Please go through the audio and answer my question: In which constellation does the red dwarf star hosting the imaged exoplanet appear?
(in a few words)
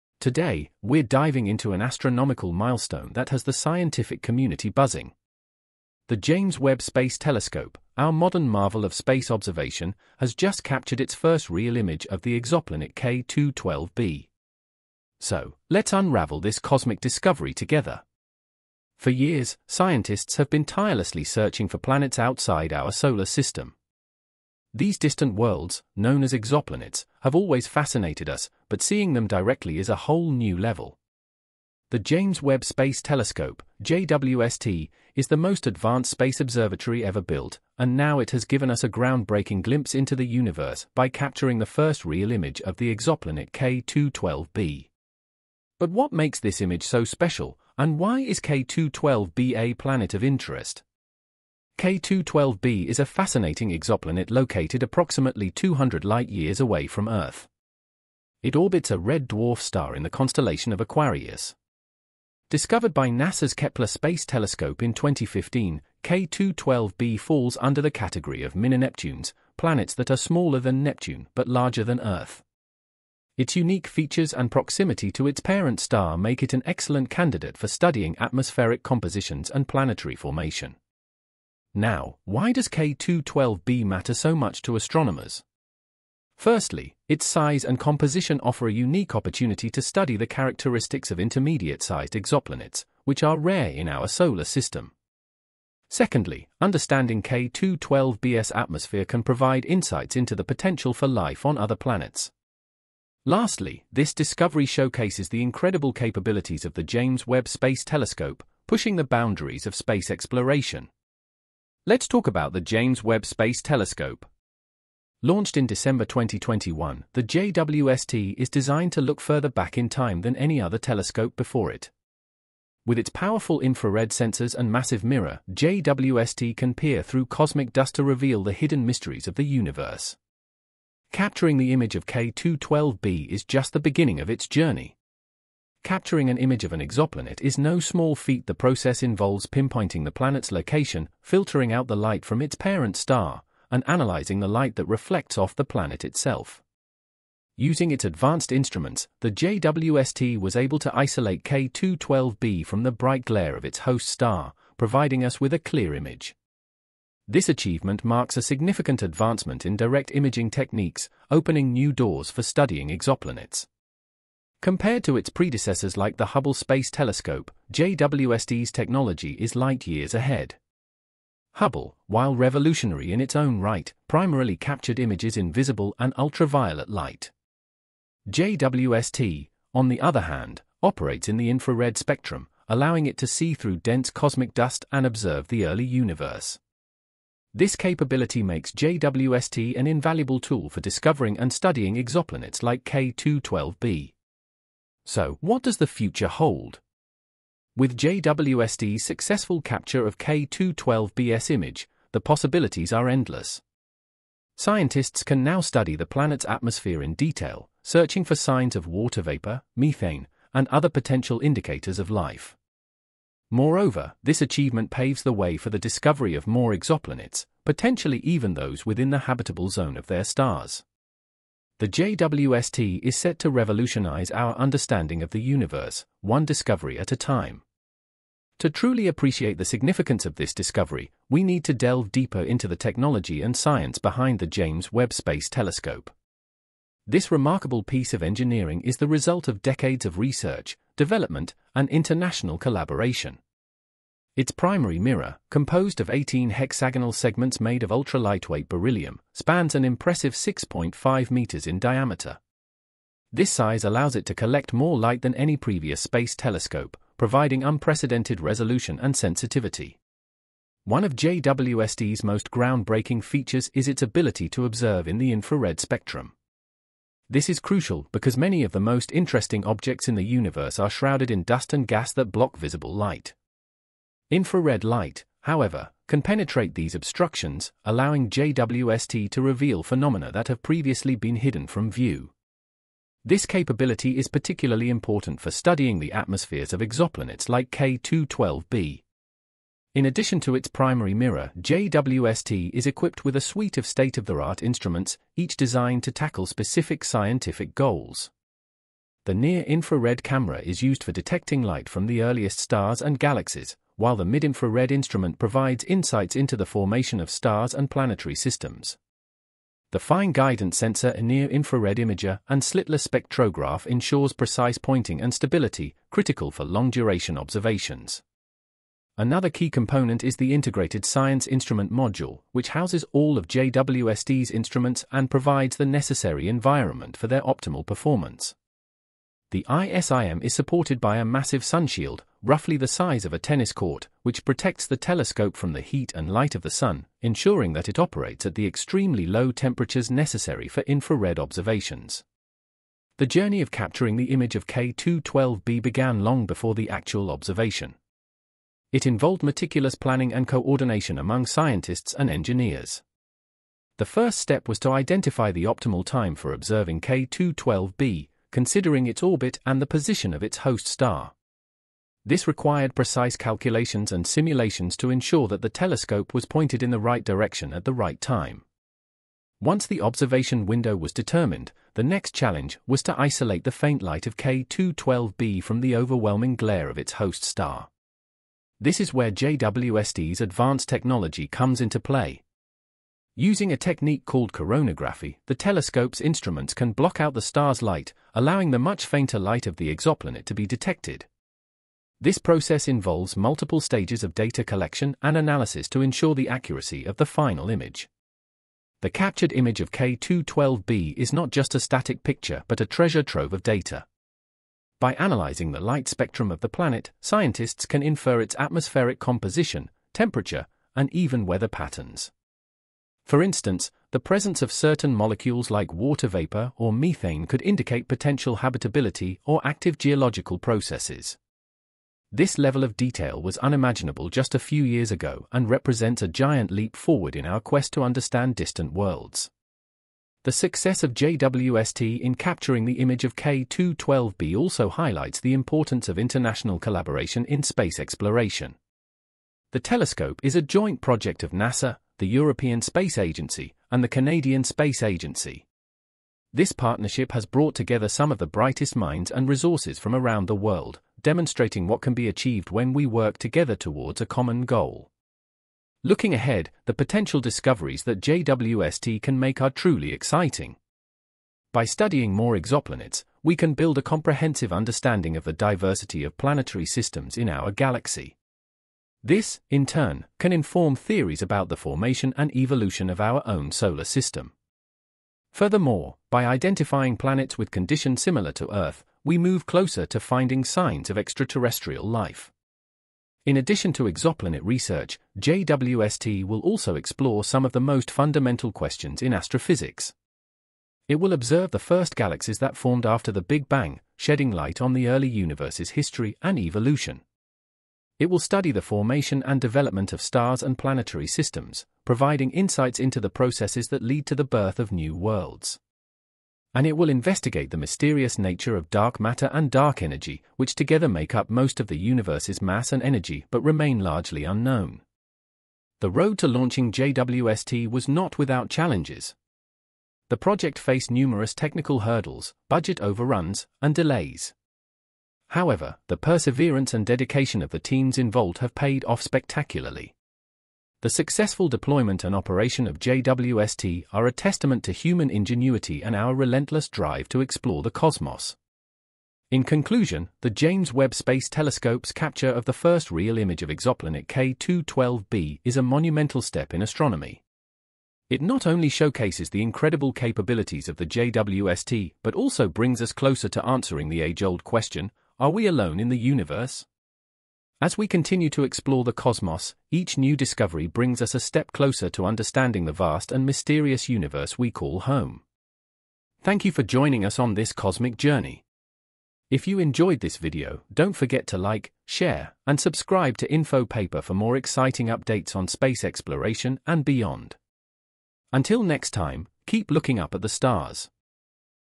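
Aquarius.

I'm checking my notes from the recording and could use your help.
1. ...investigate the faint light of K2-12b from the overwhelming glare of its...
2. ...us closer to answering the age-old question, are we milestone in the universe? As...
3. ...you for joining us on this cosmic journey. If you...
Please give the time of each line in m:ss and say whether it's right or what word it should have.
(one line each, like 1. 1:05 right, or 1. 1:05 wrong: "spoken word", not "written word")
1. 6:13 wrong: "isolate", not "investigate"
2. 9:13 wrong: "alone", not "milestone"
3. 9:26 right.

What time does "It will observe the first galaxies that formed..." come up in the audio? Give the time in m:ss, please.
8:11.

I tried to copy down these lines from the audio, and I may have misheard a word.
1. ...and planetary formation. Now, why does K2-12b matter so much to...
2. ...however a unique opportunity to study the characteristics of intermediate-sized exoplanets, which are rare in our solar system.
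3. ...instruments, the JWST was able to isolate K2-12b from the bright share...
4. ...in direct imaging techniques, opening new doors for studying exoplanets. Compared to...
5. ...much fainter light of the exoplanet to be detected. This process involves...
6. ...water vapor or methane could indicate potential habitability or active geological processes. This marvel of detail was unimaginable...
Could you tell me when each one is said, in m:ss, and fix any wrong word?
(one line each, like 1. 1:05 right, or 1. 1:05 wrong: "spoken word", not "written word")
1. 1:19 right
2. 1:28 wrong: "offer", not "however"
3. 2:28 wrong: "glare", not "share"
4. 2:39 right
5. 6:28 right
6. 6:55 wrong: "level", not "marvel".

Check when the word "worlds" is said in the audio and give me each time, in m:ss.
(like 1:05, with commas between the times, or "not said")
0:25, 7:08, 7:30, 8:25.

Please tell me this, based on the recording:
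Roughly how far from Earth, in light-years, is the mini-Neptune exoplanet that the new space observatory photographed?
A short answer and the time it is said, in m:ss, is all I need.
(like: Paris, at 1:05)
200 light-years, at 0:55.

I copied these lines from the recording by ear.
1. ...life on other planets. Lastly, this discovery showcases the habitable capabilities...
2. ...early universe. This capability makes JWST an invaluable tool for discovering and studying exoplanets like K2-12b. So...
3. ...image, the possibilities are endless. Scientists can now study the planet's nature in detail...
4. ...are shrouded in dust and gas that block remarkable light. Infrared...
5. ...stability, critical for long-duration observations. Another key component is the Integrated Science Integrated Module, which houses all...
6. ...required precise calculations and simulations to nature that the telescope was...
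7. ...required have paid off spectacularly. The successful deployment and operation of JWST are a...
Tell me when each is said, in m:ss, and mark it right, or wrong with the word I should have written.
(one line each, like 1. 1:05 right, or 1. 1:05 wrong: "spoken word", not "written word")
1. 1:41 wrong: "incredible", not "habitable"
2. 3:05 right
3. 3:21 wrong: "atmosphere", not "nature"
4. 4:30 wrong: "visible", not "remarkable"
5. 5:15 wrong: "Instrument", not "Integrated"
6. 6:02 wrong: "ensure", not "nature"
7. 8:48 wrong: "involved", not "required".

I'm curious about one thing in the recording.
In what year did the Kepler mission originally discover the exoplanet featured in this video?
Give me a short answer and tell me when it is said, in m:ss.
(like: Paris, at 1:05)
2015, at 1:04.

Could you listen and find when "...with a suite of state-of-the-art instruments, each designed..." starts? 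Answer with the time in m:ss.
4:53.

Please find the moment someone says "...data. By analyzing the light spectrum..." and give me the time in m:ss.
6:43.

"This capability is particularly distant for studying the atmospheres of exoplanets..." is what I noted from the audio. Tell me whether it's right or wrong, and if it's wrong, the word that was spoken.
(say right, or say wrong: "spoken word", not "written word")
wrong: "important", not "distant".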